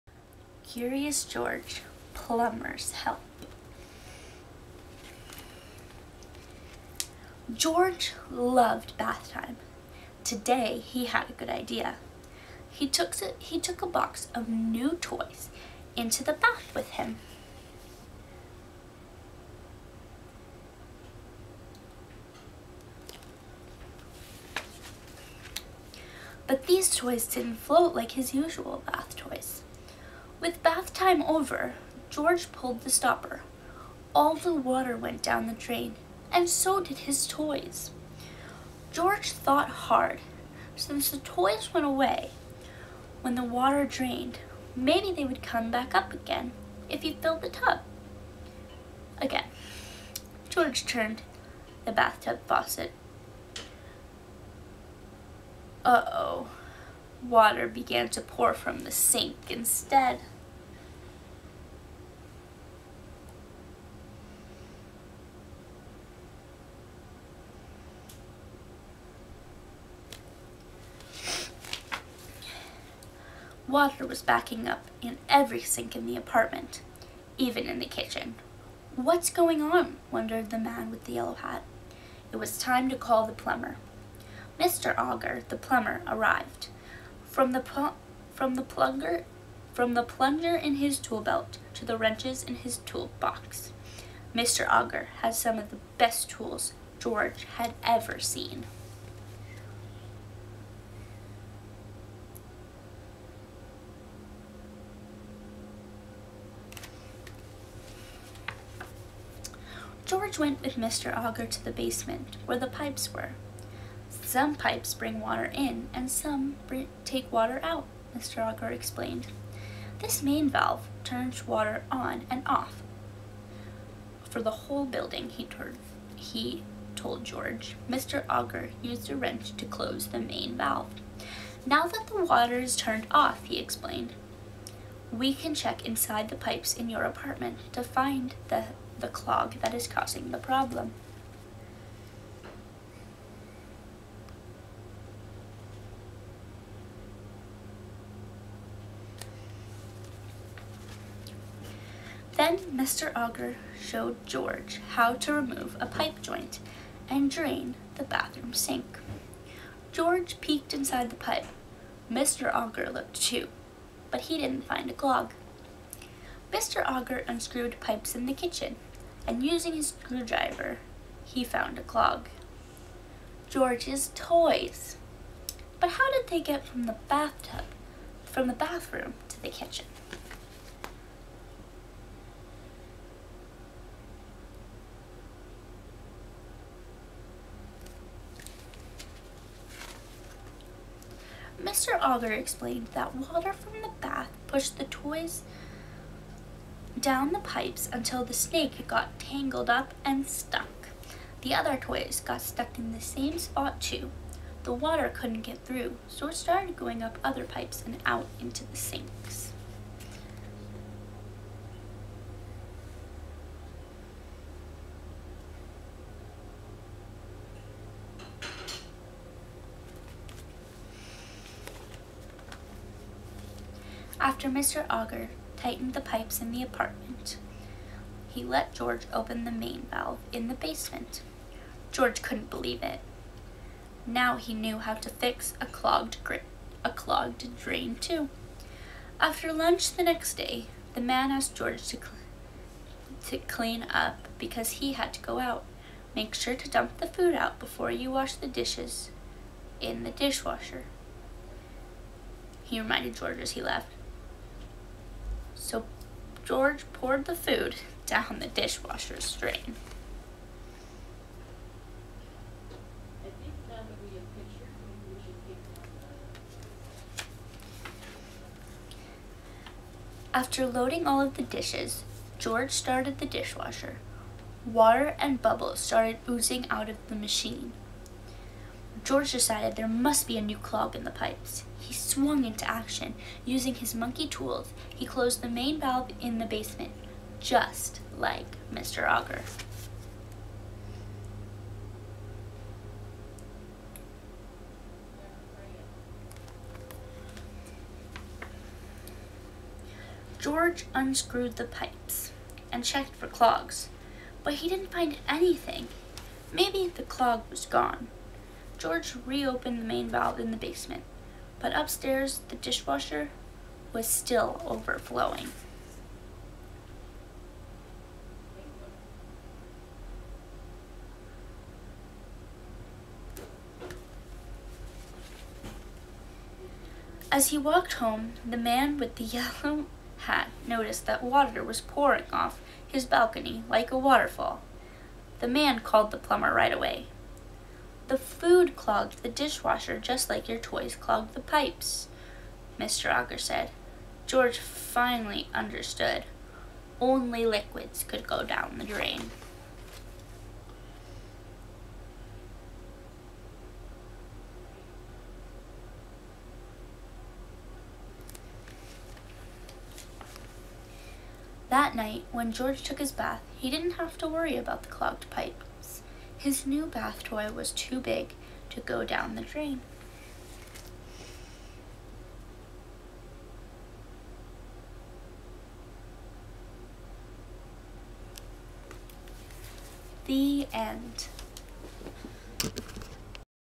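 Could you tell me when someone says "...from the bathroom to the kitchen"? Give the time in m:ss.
2:58.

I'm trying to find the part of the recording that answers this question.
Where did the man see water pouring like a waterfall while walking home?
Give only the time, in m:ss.
5:33.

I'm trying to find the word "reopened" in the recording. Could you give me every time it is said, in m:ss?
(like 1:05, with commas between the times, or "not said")
5:09.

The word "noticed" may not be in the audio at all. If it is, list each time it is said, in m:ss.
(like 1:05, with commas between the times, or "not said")
5:30.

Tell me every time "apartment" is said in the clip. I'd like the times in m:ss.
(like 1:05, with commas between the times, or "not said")
1:16, 2:17, 3:46.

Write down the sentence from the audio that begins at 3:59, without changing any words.
After lunch the next day, the man asked George to, cl to clean up because he had to go out.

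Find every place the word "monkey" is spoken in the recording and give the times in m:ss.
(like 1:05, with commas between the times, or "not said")
4:43.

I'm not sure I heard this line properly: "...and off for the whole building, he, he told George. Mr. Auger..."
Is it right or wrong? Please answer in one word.
right.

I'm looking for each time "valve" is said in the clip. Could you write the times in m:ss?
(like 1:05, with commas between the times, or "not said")
2:00, 2:10, 3:49, 4:45, 5:10.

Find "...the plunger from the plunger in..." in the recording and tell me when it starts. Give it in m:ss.
1:28.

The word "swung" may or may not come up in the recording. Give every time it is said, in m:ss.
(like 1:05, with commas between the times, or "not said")
4:41.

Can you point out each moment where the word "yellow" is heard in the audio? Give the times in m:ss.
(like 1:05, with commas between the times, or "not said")
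1:21, 5:29.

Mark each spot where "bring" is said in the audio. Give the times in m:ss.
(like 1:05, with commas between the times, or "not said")
1:54.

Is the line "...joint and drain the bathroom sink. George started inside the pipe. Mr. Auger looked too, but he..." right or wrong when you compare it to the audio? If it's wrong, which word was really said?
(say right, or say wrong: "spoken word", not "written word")
wrong: "peeked", not "started".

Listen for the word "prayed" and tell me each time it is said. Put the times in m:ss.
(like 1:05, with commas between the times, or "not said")
not said.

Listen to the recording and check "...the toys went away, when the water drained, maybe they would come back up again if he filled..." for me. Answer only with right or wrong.
right.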